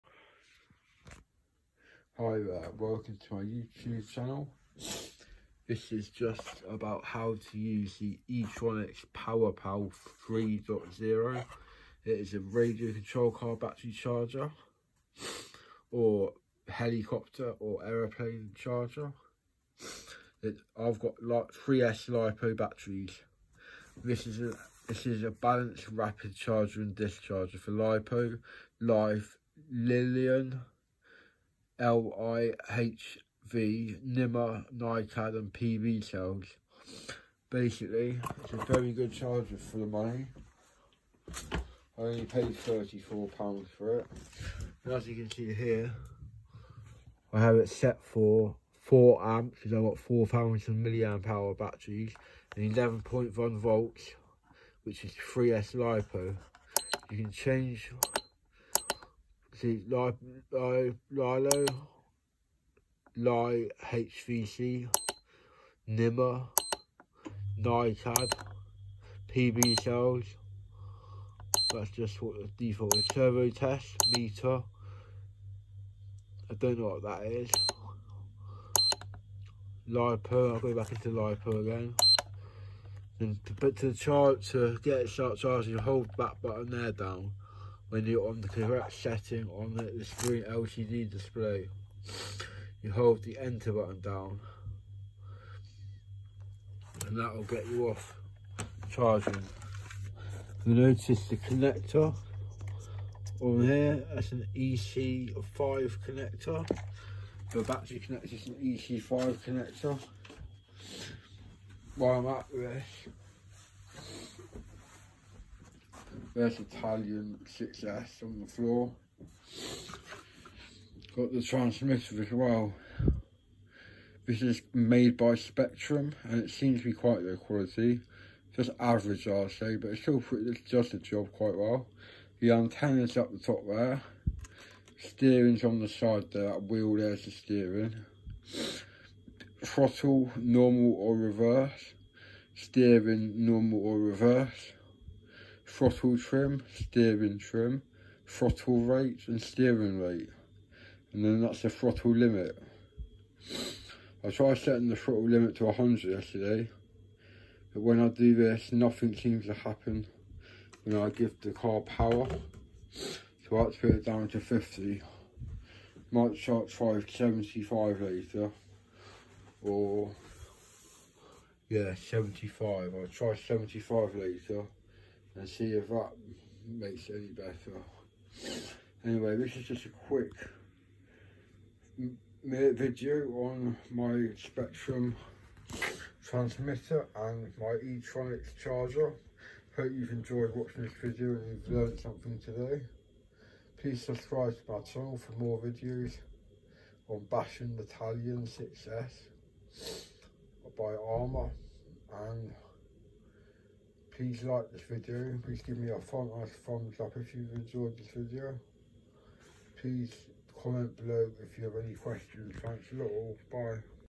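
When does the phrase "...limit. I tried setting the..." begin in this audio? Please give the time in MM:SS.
02:32.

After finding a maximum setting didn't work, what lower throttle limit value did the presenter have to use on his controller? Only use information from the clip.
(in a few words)
50.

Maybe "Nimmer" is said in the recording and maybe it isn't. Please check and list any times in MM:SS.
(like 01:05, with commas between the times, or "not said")
01:05.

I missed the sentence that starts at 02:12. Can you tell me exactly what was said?
The antenna's up the top there.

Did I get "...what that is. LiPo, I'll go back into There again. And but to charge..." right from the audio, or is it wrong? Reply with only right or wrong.
wrong.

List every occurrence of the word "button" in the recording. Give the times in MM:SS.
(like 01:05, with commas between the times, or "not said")
01:26, 01:33.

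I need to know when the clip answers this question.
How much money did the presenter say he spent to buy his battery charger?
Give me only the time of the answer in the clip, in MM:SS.
00:42.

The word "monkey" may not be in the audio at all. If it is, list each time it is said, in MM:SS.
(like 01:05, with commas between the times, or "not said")
not said.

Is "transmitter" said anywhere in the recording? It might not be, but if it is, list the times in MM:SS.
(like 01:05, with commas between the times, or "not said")
02:01, 03:06.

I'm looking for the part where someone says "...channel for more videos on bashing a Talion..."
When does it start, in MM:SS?
03:14.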